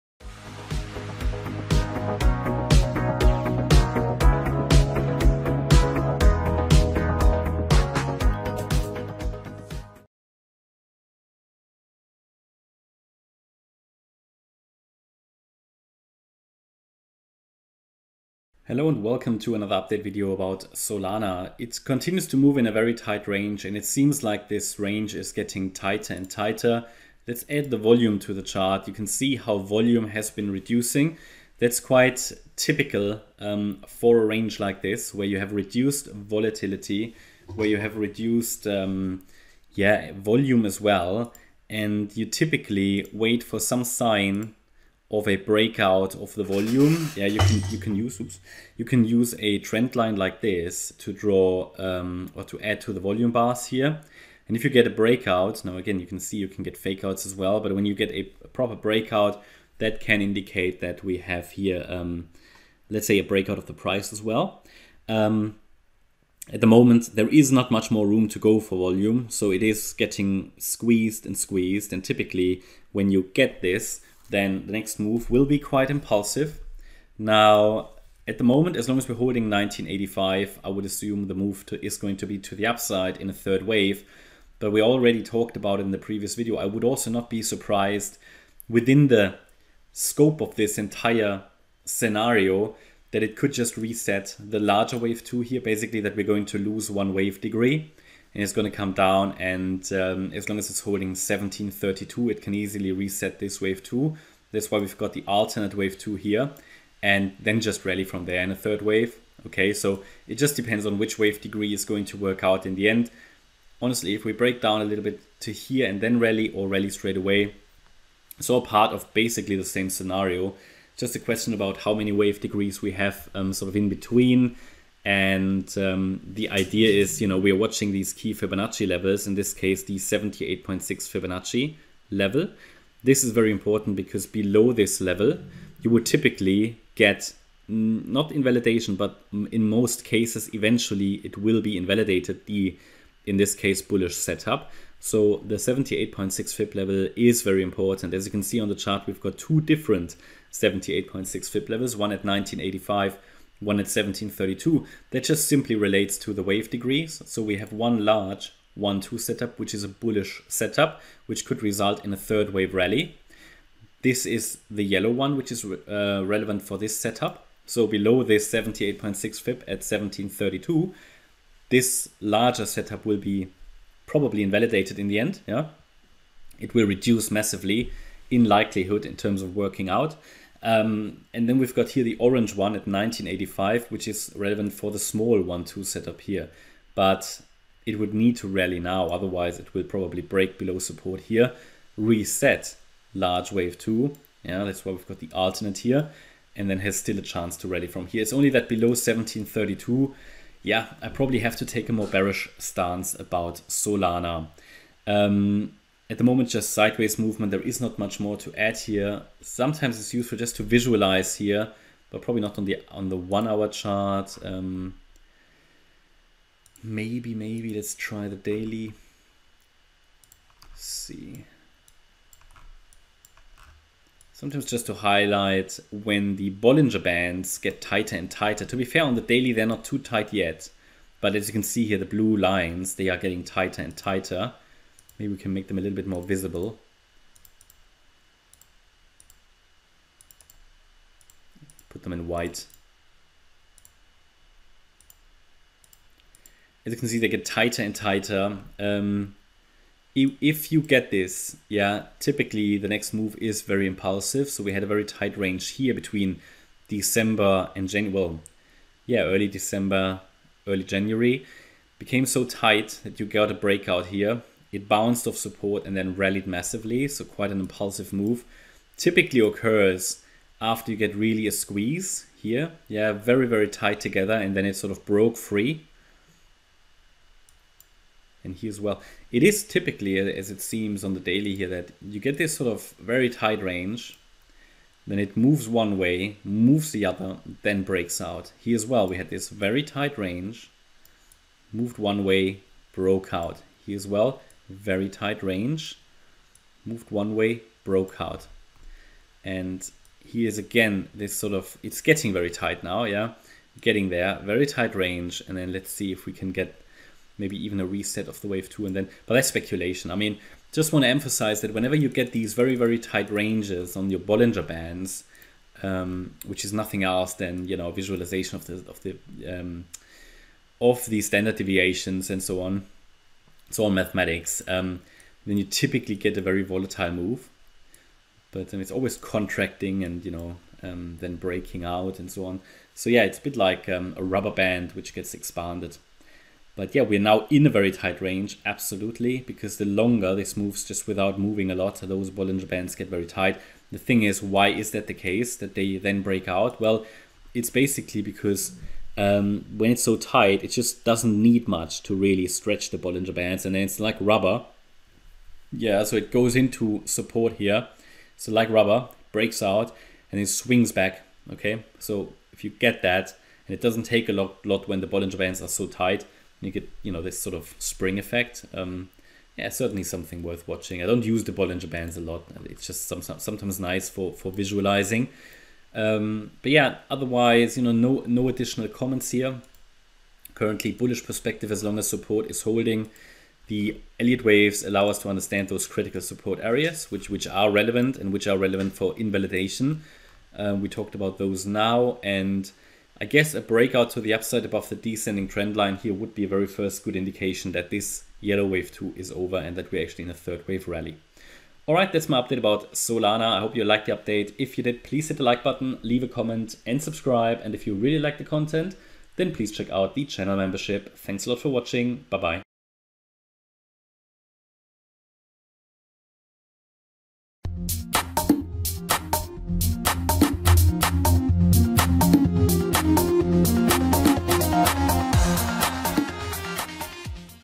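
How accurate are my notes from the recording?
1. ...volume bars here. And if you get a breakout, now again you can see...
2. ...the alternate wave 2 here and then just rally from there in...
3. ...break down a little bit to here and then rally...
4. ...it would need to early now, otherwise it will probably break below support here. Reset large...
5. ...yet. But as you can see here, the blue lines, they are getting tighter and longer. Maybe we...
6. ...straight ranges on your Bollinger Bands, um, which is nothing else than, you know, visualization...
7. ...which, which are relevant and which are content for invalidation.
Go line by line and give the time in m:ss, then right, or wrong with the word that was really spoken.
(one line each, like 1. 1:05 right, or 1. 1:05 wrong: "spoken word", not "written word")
1. 0:52 right
2. 1:45 right
3. 1:54 right
4. 3:07 wrong: "rally", not "early"
5. 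3:50 wrong: "tighter", not "longer"
6. 5:12 wrong: "tight", not "straight"
7. 6:27 wrong: "relevant", not "content".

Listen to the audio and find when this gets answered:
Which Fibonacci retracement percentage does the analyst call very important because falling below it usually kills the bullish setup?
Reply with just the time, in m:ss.
2:09.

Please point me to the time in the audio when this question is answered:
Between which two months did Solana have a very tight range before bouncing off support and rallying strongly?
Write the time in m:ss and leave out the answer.
4:15.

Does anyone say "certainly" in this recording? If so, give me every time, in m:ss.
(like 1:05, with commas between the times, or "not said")
6:09.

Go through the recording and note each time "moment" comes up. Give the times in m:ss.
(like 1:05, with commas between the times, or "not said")
1:06, 1:18, 3:26.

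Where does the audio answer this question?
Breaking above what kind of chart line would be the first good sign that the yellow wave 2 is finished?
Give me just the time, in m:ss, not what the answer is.
6:34.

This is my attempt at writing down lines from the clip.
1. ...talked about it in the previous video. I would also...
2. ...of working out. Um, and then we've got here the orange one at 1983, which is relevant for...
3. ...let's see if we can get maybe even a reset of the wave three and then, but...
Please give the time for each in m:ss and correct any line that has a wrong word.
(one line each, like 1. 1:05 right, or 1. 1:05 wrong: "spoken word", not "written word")
1. 1:25 right
2. 2:59 wrong: "1985", not "1983"
3. 5:05 wrong: "two", not "three".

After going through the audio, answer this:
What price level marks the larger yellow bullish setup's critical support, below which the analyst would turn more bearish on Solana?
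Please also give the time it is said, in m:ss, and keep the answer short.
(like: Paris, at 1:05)
1732, at 2:49.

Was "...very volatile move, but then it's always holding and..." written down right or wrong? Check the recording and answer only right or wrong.
wrong.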